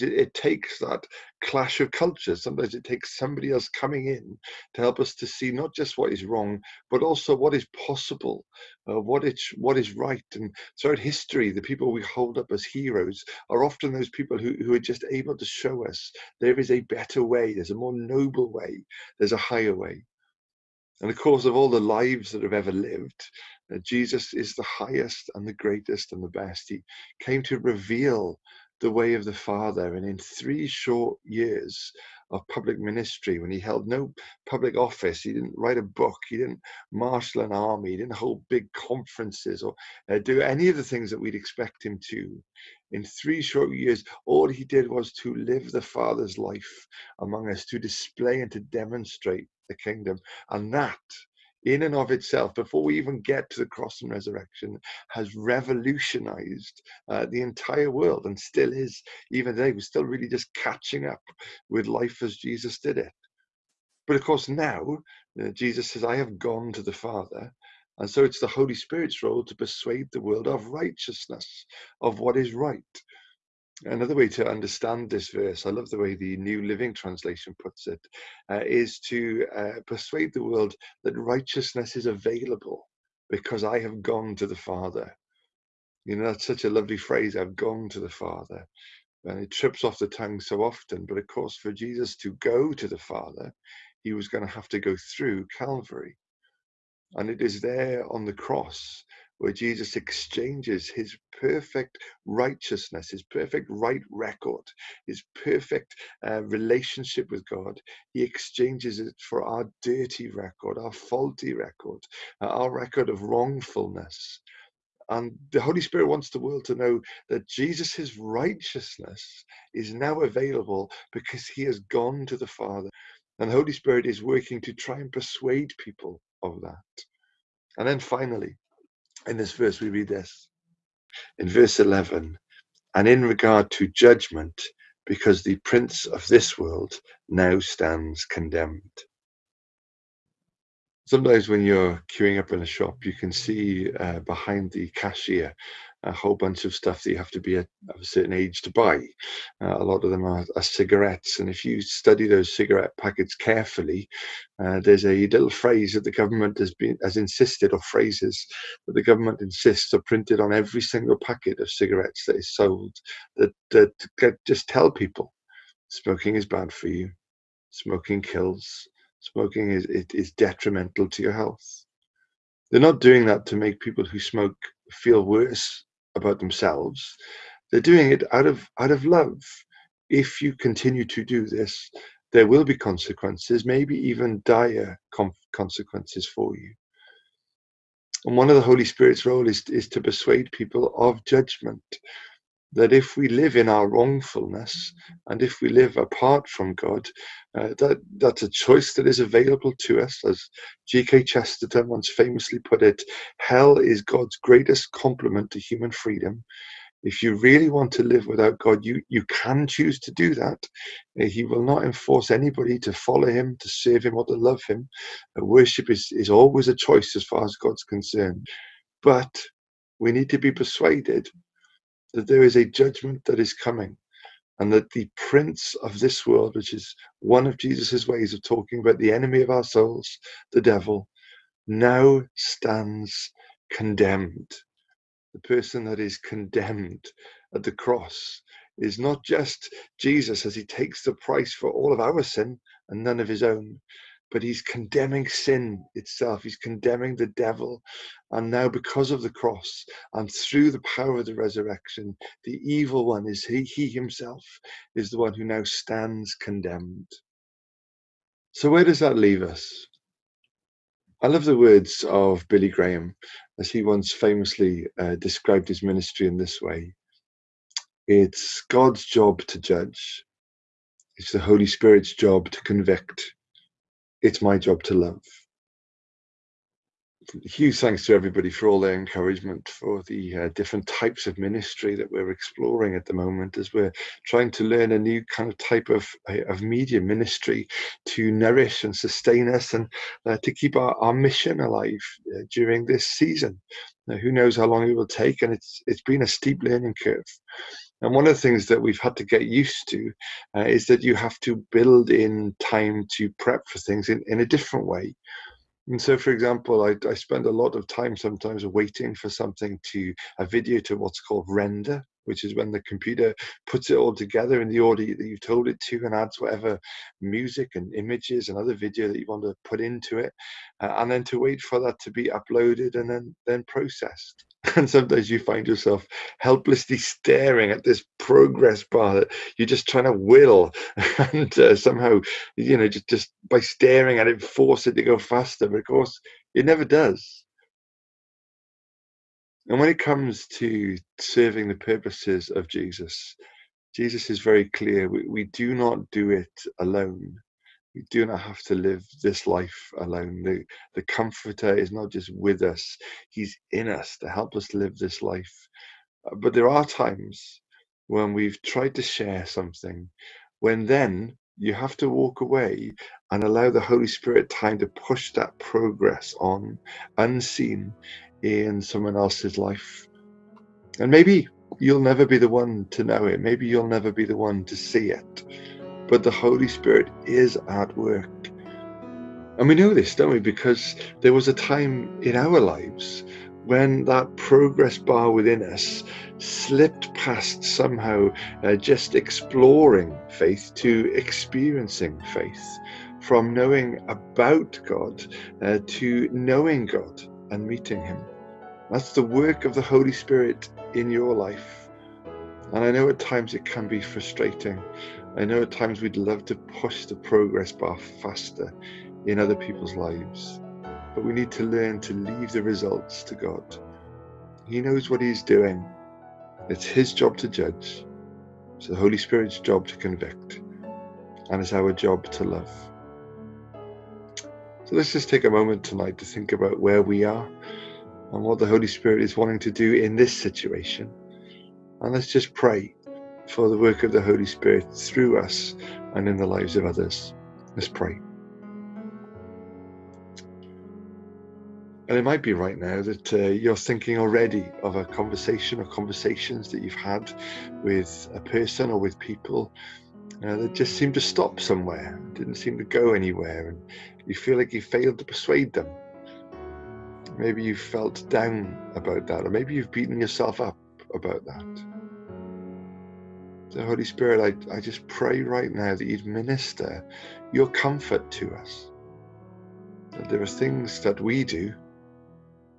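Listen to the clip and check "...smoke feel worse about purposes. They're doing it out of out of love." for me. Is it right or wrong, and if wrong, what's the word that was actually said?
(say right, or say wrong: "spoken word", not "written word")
wrong: "themselves", not "purposes".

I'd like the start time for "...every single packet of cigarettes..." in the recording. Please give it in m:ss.
2:40.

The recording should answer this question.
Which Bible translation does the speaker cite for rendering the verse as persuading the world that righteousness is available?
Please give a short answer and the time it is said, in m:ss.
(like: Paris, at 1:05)
New Living Translation, at 1:16.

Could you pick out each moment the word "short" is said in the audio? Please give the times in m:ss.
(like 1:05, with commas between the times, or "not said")
0:30, 0:43.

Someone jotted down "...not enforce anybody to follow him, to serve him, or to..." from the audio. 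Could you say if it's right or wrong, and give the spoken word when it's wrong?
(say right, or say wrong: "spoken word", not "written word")
right.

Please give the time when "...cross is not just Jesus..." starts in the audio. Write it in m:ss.
3:57.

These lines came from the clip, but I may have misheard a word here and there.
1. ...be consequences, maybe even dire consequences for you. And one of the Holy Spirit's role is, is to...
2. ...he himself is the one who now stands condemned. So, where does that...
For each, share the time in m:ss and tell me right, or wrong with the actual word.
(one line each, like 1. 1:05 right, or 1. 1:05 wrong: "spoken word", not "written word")
1. 3:02 right
2. 4:13 right.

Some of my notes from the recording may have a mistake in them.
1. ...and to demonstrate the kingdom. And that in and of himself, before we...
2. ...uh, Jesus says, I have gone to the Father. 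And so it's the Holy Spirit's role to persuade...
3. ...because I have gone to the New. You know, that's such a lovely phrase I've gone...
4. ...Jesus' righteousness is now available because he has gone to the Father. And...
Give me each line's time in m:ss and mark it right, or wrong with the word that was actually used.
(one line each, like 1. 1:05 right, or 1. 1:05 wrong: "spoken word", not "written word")
1. 0:48 wrong: "itself", not "himself"
2. 1:05 right
3. 1:23 wrong: "Father", not "New"
4. 1:57 right.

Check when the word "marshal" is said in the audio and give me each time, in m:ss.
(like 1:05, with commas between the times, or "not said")
0:36.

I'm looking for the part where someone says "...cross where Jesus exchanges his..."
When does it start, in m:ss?
1:38.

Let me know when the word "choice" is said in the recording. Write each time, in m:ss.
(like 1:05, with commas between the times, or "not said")
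3:18, 3:36.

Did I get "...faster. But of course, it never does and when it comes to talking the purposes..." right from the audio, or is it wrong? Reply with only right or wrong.
wrong.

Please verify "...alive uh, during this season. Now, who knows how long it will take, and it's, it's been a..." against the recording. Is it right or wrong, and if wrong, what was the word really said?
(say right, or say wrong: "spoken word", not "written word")
right.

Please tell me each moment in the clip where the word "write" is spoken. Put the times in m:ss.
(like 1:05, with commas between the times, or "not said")
0:35.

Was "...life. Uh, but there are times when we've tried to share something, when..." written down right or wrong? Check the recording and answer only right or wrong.
right.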